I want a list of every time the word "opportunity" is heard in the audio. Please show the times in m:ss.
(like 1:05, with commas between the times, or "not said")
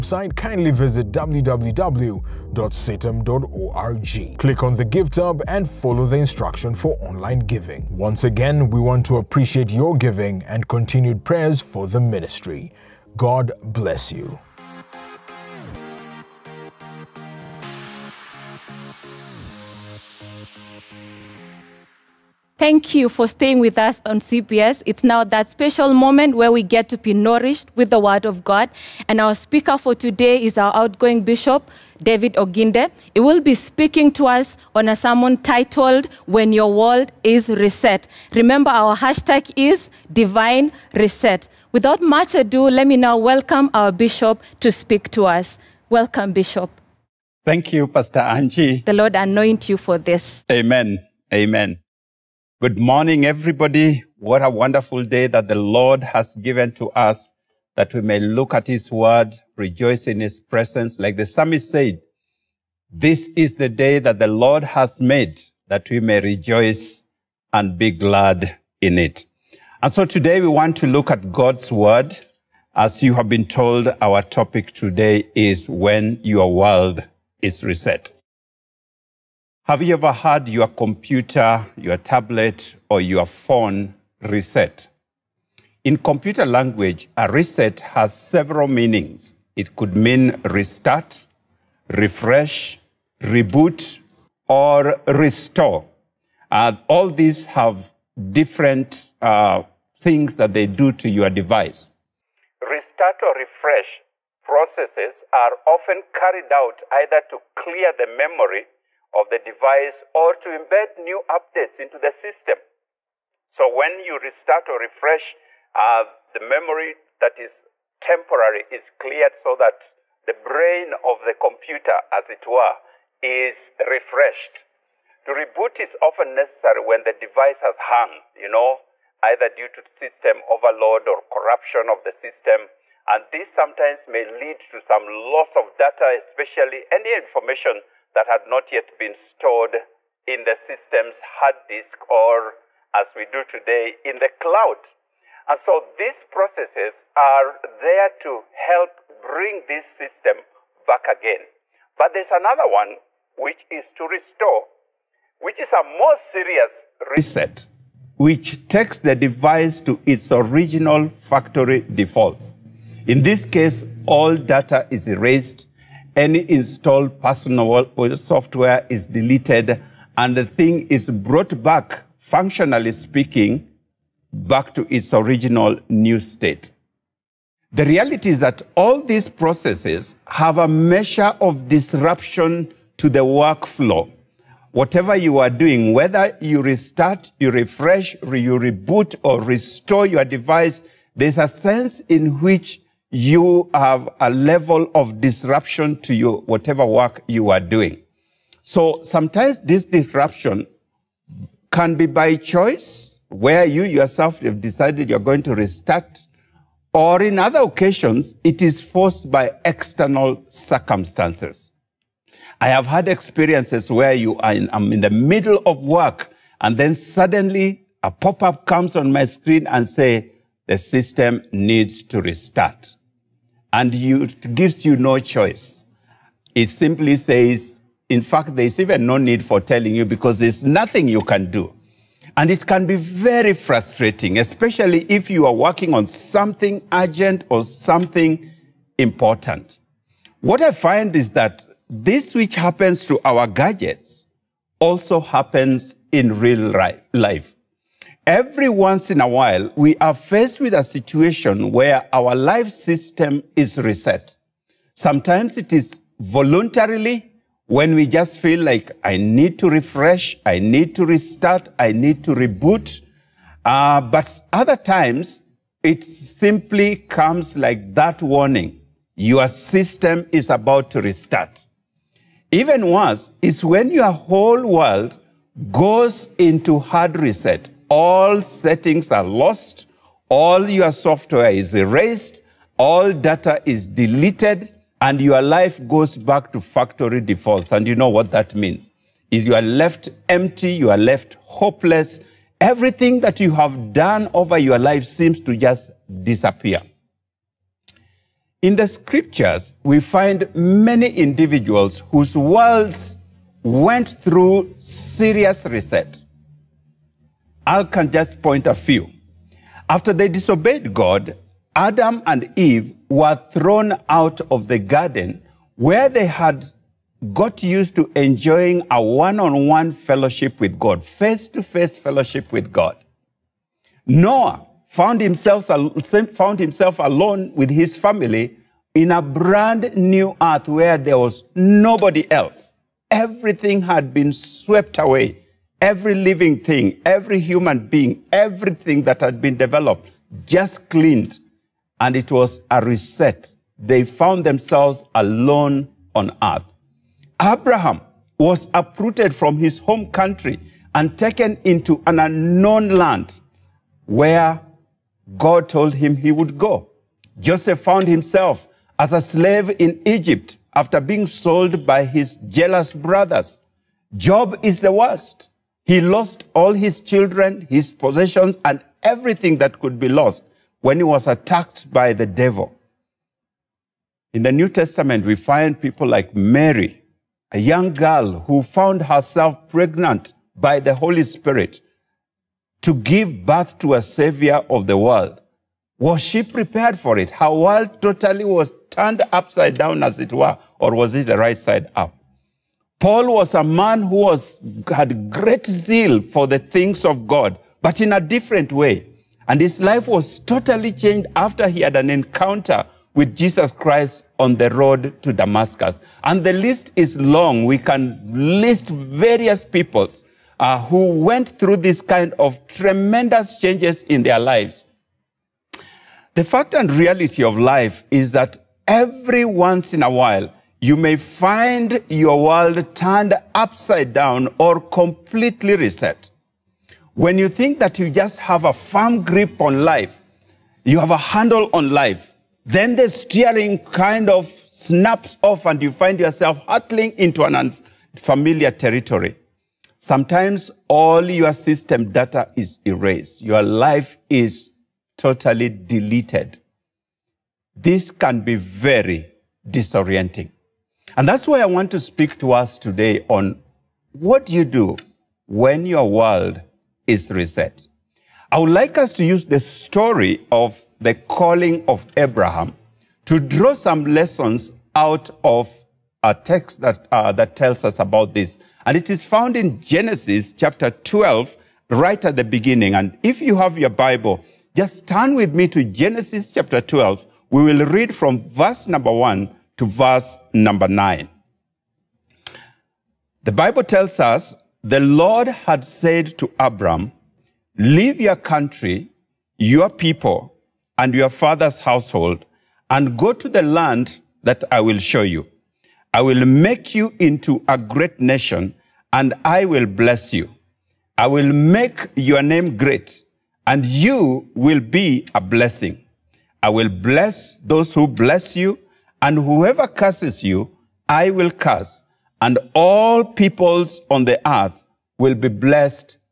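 not said.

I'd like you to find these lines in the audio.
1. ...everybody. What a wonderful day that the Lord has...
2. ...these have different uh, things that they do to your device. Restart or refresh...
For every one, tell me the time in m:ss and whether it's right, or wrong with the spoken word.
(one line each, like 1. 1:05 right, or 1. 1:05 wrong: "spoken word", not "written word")
1. 0:53 right
2. 1:37 right.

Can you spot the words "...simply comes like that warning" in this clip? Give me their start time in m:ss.
4:26.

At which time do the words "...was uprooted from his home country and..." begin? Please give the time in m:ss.
5:48.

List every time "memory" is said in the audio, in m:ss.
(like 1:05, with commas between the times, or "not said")
1:48, 1:56.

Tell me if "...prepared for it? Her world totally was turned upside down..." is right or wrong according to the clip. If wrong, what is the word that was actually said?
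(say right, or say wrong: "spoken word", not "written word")
right.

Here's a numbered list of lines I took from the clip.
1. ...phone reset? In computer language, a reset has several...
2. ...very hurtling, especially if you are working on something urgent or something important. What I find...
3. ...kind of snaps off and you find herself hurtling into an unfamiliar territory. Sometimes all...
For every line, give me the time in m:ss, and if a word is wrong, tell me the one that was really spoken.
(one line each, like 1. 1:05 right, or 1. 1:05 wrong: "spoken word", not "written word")
1. 1:23 right
2. 3:52 wrong: "frustrating", not "hurtling"
3. 7:13 wrong: "yourself", not "herself".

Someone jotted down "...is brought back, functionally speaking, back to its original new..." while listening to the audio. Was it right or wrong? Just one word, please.
right.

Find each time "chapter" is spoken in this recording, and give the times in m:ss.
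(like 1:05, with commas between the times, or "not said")
7:50, 7:56.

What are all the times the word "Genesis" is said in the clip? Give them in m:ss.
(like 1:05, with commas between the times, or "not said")
7:49, 7:55.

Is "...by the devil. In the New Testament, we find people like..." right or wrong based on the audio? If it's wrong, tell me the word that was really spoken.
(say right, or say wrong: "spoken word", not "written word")
right.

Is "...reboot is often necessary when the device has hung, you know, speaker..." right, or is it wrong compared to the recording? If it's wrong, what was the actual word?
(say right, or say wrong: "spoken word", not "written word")
wrong: "either", not "speaker".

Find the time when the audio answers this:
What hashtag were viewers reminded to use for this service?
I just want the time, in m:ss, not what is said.
0:40.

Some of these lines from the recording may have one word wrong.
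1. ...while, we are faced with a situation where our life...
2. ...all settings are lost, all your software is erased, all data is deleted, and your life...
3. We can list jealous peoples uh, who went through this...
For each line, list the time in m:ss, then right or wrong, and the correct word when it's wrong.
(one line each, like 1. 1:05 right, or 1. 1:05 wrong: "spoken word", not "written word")
1. 4:09 right
2. 4:37 right
3. 6:47 wrong: "various", not "jealous".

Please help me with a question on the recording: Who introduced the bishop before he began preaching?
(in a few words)
Pastor Angie.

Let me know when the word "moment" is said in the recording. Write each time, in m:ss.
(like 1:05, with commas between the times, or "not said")
0:25.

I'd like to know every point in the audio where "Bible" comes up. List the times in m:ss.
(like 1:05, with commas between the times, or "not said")
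7:53, 8:03.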